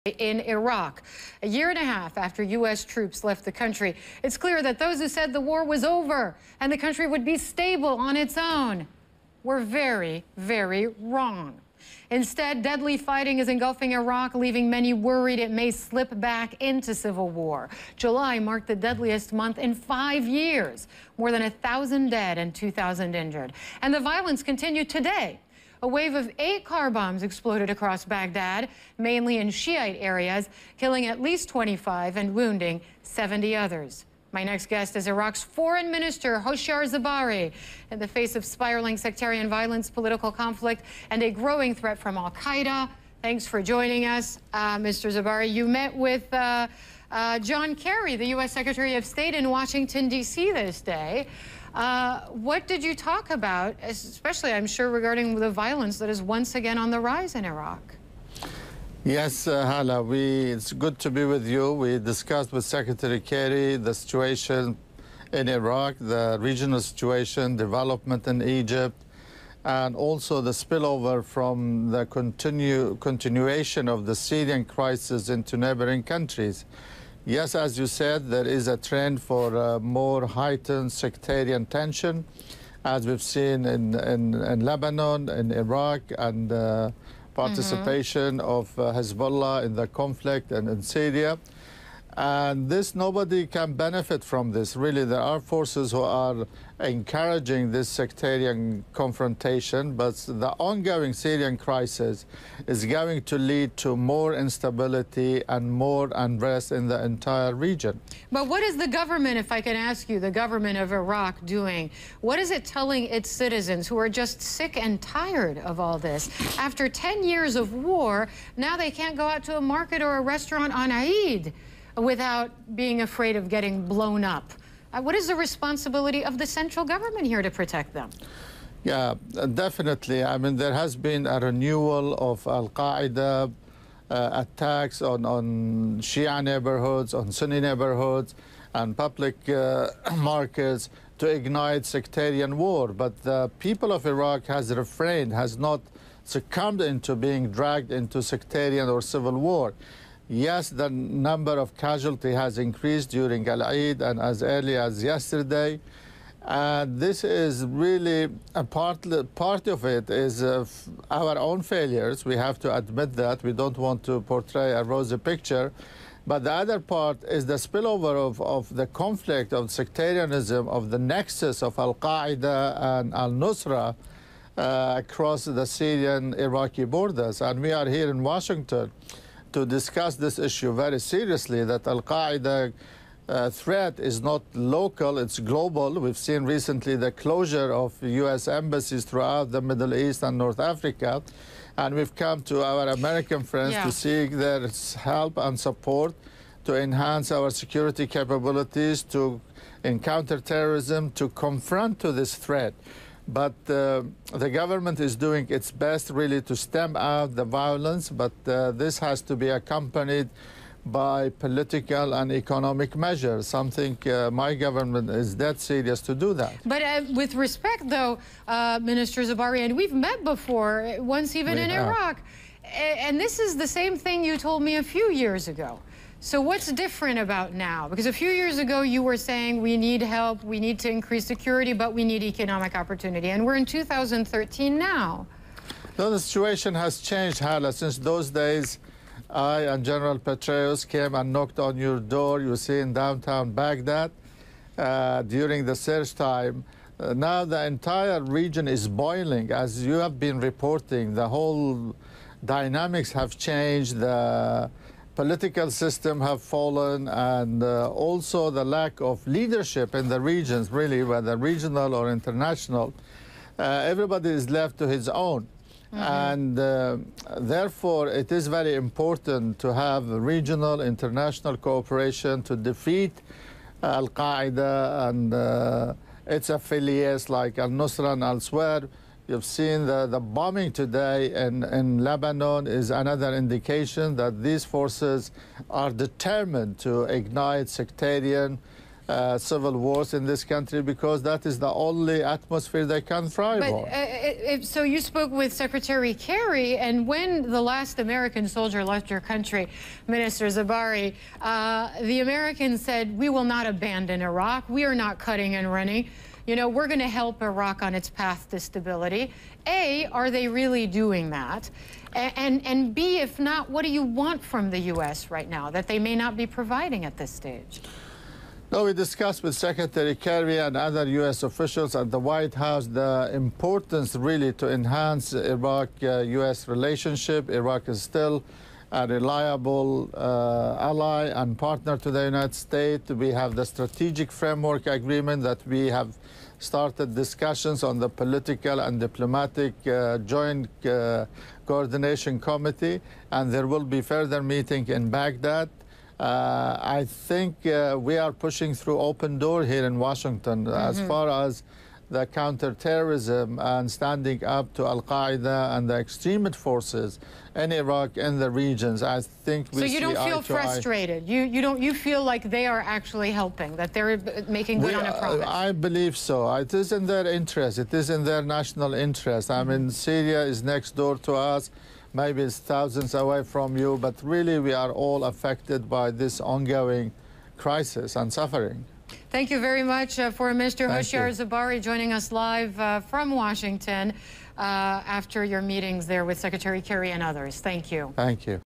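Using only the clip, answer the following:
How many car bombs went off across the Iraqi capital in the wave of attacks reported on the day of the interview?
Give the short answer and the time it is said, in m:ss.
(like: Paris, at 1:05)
8, at 0:26.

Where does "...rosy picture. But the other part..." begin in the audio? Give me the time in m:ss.
2:44.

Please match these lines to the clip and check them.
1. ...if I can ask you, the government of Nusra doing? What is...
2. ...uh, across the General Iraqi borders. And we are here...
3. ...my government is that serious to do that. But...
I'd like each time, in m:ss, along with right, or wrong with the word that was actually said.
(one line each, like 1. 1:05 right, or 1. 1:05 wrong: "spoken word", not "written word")
1. 1:49 wrong: "Iraq", not "Nusra"
2. 2:54 wrong: "Syrian", not "General"
3. 3:34 right.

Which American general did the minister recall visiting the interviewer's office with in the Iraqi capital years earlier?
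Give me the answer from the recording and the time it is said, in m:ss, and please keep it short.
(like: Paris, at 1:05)
General Petraeus, at 3:59.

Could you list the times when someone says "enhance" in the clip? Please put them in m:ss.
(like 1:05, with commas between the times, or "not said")
3:16, 5:24.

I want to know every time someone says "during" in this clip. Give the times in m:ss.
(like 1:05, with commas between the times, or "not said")
2:33, 4:05.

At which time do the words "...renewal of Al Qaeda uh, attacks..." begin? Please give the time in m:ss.
2:11.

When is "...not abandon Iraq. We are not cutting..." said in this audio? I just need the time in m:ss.
5:03.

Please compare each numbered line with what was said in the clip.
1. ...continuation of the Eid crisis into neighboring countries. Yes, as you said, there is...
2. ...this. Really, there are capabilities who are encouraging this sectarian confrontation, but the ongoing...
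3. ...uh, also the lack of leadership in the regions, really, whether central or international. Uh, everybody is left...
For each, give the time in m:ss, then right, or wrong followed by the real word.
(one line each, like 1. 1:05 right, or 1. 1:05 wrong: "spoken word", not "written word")
1. 1:12 wrong: "Syrian", not "Eid"
2. 1:34 wrong: "forces", not "capabilities"
3. 4:17 wrong: "regional", not "central".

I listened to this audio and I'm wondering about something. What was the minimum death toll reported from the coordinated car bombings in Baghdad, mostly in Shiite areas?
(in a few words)
25.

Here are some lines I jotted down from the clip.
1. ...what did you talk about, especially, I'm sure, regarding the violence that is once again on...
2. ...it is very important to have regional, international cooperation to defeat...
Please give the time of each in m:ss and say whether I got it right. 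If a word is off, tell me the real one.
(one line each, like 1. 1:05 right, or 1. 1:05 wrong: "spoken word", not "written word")
1. 0:52 right
2. 4:28 right.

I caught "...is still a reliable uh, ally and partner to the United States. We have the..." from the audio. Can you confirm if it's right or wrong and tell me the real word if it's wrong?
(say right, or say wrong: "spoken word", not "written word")
right.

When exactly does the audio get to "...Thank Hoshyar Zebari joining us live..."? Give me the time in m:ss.
6:20.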